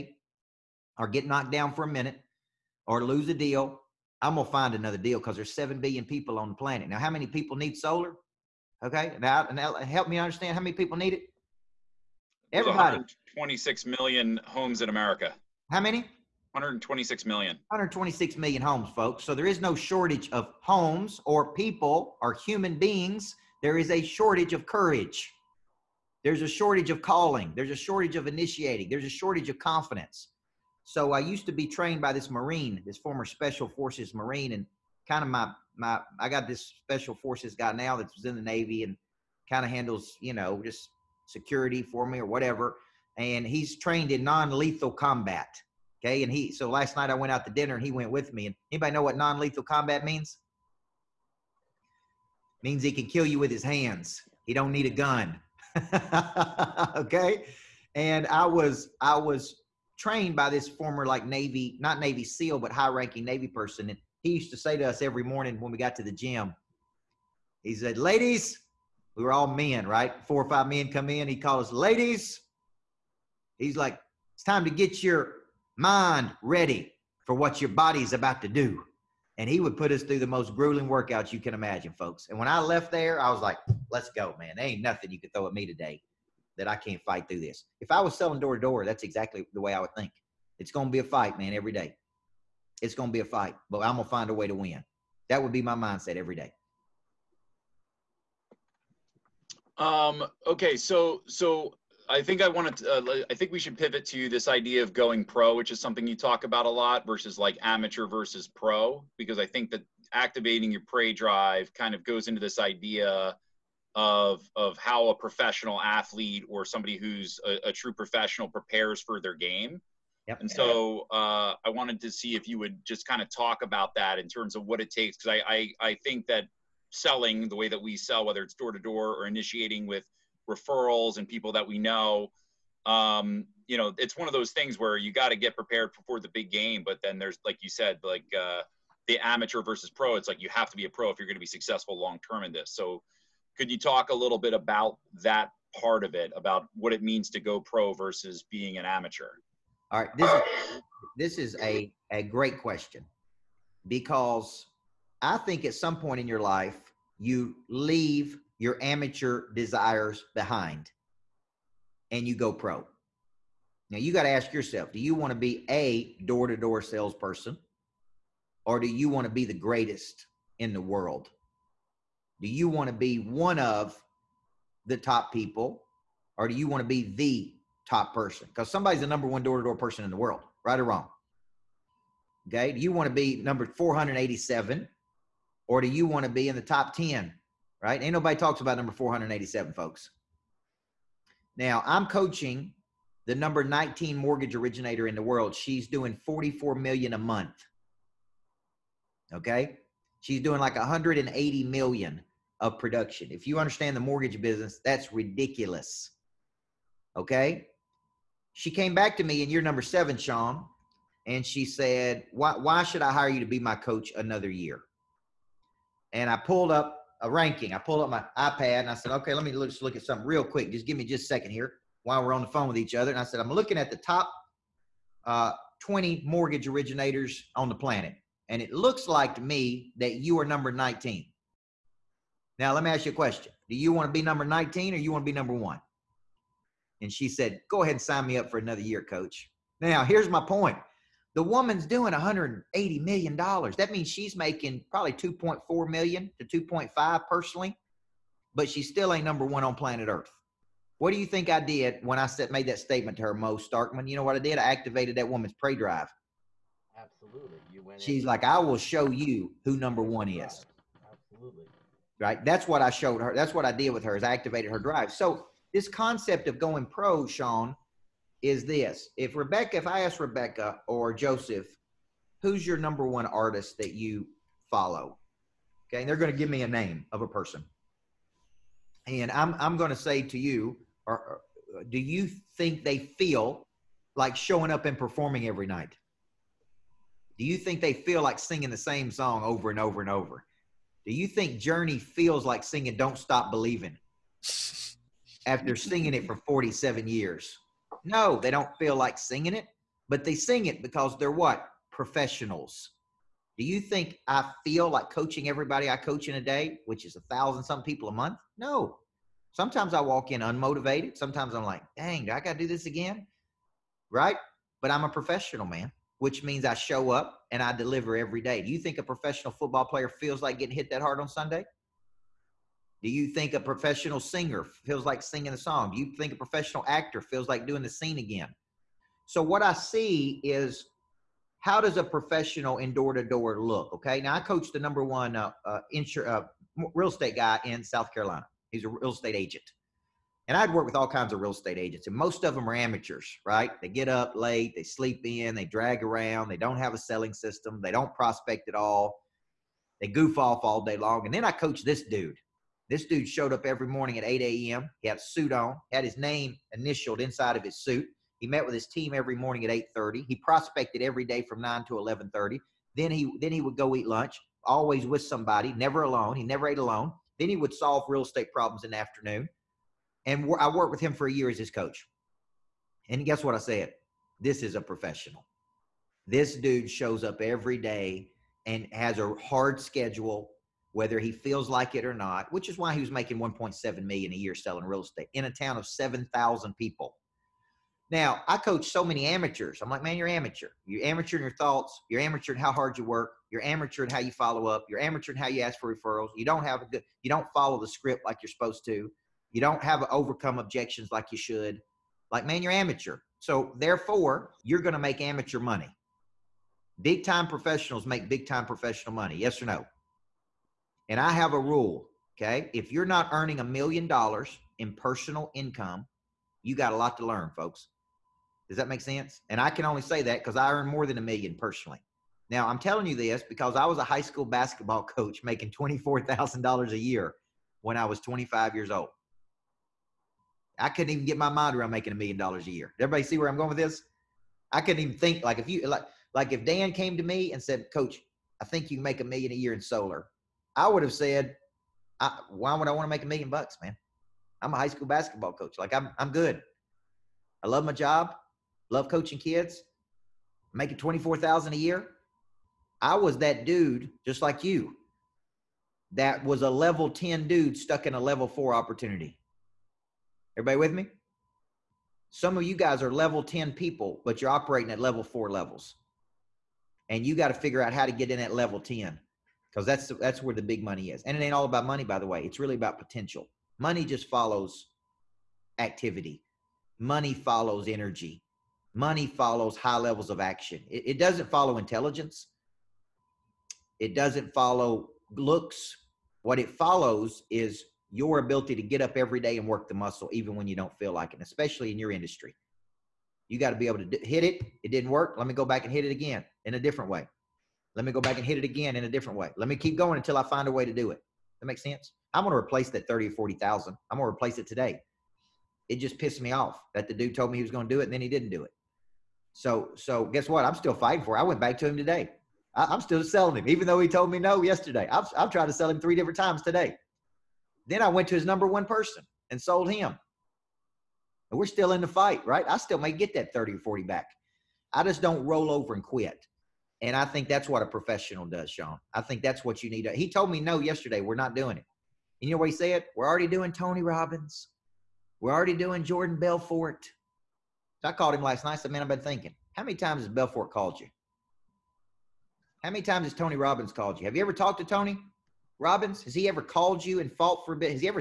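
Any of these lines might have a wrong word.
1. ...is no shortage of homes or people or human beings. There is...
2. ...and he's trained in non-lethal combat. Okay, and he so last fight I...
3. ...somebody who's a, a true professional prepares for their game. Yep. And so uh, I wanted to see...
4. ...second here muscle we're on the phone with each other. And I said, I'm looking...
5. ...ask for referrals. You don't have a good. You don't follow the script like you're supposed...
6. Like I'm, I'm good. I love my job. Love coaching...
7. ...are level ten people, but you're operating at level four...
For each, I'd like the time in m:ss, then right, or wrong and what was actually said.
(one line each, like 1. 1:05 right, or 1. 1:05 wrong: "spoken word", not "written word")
1. 0:19 right
2. 0:43 wrong: "night", not "fight"
3. 1:56 right
4. 3:41 wrong: "while", not "muscle"
5. 6:35 right
6. 7:25 right
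7. 7:43 right.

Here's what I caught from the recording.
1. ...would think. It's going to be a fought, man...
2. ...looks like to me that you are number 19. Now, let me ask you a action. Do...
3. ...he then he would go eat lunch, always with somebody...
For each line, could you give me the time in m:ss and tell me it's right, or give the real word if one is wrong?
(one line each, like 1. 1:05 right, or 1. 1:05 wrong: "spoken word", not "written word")
1. 1:29 wrong: "fight", not "fought"
2. 3:48 wrong: "question", not "action"
3. 6:03 right.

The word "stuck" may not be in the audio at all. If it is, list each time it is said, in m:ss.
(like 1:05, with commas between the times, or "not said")
7:37.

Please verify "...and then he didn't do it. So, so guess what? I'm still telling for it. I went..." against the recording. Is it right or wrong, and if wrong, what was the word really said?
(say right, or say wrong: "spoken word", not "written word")
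wrong: "fighting", not "telling".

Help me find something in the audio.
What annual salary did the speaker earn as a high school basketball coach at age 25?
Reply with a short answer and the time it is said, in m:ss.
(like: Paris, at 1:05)
$24,000, at 7:05.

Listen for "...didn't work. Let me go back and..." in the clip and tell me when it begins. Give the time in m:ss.
8:14.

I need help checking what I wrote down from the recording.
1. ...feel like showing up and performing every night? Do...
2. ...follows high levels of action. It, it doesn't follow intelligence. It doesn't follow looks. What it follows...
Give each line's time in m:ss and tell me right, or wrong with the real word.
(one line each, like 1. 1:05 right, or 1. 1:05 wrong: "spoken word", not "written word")
1. 4:42 right
2. 7:59 right.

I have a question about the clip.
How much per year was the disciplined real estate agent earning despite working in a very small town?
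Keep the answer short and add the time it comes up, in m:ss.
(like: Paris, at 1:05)
1.7 million, at 6:23.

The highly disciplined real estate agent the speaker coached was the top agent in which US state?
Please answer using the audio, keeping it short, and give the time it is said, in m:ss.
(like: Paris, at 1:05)
South Carolina, at 5:37.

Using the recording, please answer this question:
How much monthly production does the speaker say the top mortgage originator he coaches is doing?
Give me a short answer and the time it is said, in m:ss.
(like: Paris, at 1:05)
44 million, at 3:16.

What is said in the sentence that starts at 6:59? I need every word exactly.
And I can only say that because I earn more than a million personally.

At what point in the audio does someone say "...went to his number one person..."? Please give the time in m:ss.
8:38.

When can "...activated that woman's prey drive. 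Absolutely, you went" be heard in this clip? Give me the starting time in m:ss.
4:14.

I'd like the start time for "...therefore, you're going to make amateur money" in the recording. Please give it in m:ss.
6:43.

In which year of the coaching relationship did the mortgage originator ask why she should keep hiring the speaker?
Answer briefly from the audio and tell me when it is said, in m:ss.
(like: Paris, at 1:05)
Year 7, at 3:29.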